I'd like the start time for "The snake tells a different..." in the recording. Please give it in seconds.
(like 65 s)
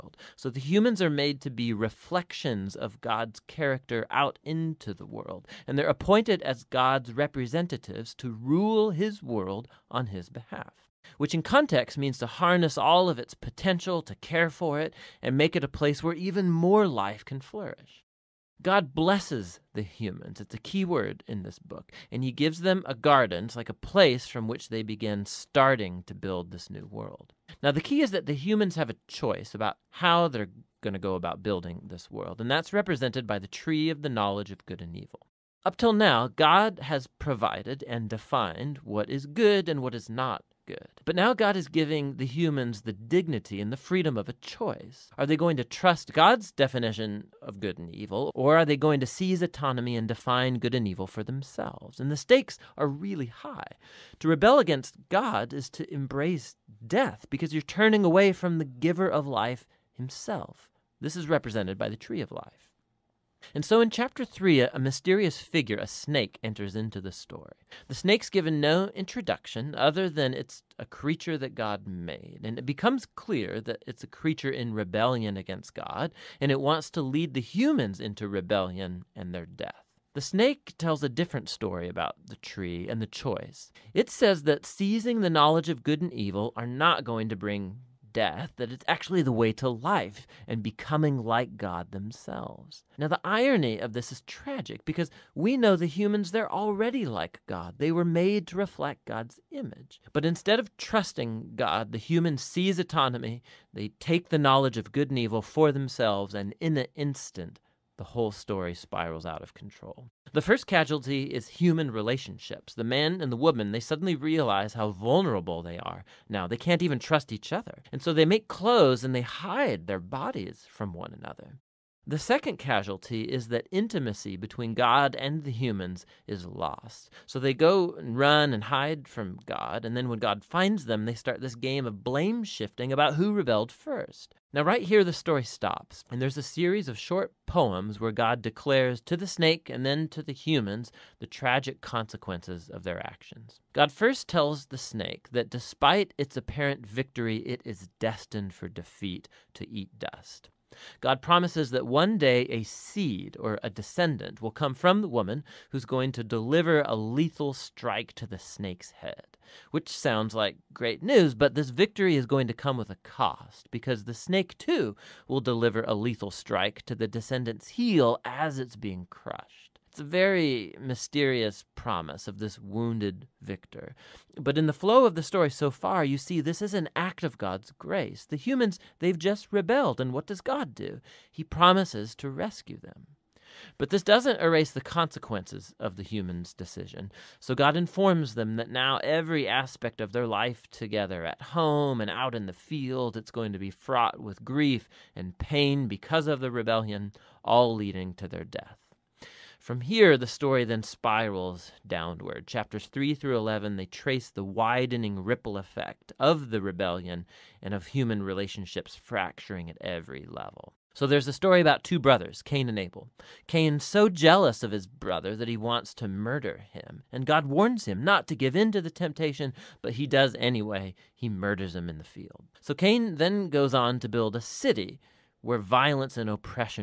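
80 s.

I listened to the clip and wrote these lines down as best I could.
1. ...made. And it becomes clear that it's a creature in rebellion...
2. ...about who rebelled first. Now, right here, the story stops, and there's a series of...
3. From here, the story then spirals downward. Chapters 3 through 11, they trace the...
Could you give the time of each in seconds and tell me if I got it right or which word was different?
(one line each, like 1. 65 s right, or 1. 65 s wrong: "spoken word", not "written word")
1. 71 s right
2. 132 s right
3. 199 s right.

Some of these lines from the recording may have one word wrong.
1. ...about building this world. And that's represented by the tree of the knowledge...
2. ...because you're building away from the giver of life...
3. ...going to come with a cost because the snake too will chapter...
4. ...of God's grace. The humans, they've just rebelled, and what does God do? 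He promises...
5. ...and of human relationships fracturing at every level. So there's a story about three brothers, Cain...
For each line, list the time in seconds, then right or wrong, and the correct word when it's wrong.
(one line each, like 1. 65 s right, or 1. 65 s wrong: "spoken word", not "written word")
1. 31 s right
2. 57 s wrong: "turning", not "building"
3. 162 s wrong: "deliver", not "chapter"
4. 177 s right
5. 207 s wrong: "two", not "three".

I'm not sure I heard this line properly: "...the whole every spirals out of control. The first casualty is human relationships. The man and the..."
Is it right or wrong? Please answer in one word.
wrong.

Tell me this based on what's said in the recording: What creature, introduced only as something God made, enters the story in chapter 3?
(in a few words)
A snake.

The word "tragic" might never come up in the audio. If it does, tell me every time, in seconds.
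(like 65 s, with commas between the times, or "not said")
94 s, 141 s.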